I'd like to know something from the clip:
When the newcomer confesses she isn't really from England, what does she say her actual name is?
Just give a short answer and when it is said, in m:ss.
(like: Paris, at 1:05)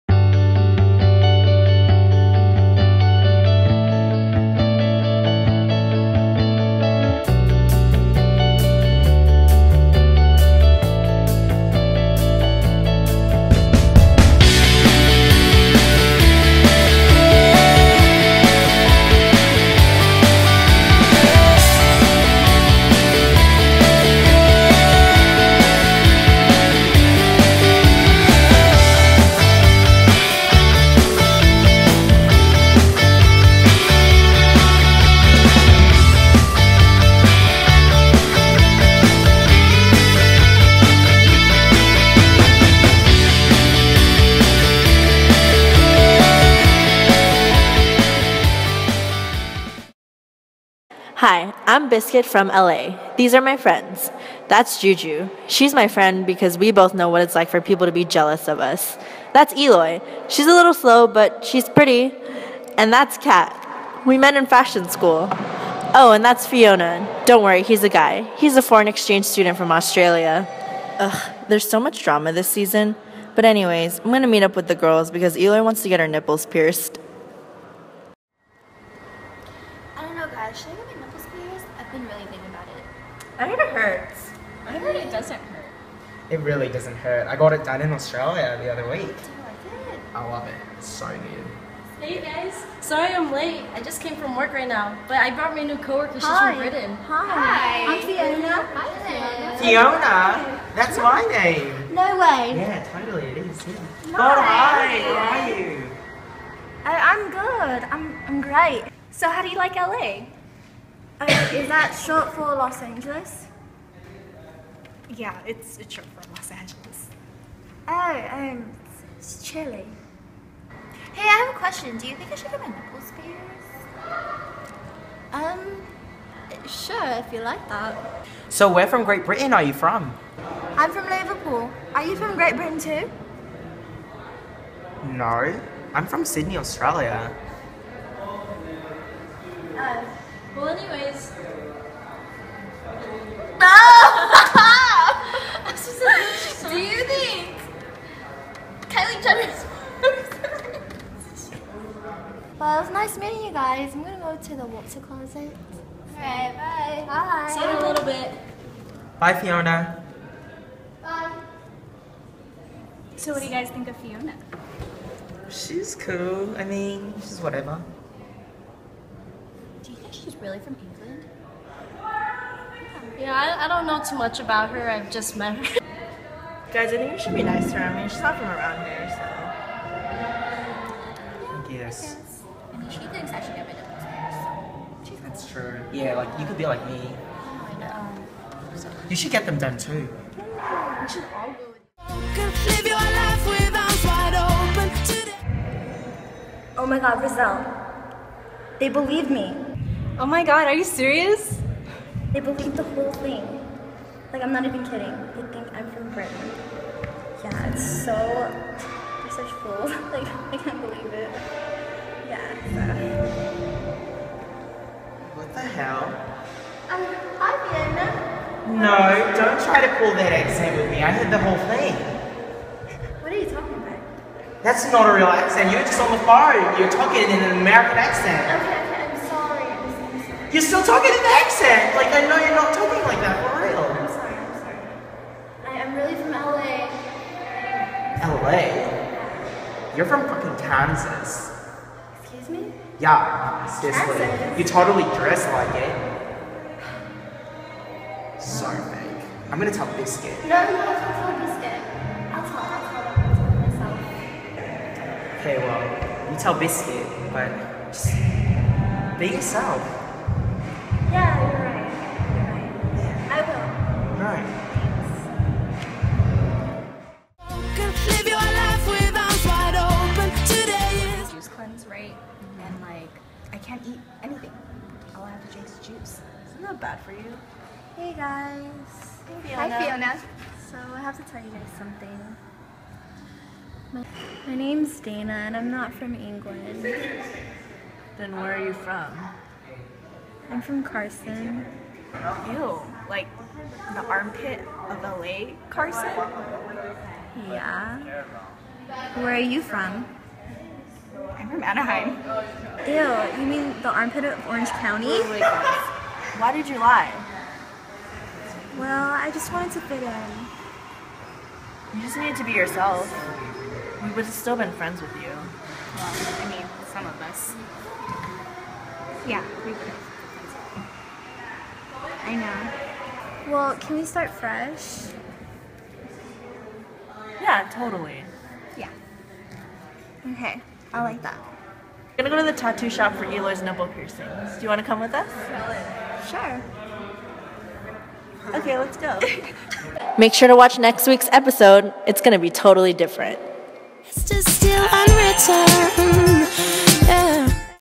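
Dana, at 4:45.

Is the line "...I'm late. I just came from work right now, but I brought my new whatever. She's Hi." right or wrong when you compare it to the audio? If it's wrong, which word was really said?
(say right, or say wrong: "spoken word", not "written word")
wrong: "coworker", not "whatever".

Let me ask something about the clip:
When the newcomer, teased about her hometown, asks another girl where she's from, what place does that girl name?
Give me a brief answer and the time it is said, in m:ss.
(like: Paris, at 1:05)
Anaheim, at 5:01.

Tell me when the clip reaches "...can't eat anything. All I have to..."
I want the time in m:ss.
4:33.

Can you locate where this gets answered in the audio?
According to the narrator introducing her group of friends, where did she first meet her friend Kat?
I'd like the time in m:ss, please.
1:04.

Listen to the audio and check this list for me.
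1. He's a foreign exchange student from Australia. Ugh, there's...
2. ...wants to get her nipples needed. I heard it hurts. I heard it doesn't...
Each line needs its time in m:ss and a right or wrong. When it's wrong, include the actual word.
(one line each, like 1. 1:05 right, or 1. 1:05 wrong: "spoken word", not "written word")
1. 1:08 right
2. 1:15 wrong: "pierced", not "needed".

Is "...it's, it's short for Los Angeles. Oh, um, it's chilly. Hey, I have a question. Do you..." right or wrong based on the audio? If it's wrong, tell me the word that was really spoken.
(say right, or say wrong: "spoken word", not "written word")
right.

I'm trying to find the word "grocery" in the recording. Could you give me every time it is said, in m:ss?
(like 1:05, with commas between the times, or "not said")
not said.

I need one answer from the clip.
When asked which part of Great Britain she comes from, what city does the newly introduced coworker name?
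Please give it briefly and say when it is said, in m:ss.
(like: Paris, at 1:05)
Liverpool, at 2:11.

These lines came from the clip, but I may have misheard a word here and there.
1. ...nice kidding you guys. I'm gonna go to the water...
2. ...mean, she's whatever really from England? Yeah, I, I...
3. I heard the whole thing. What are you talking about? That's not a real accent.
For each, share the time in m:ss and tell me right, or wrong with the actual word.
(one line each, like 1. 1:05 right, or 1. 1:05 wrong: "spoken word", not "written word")
1. 2:32 wrong: "meeting", not "kidding"
2. 2:46 right
3. 3:41 right.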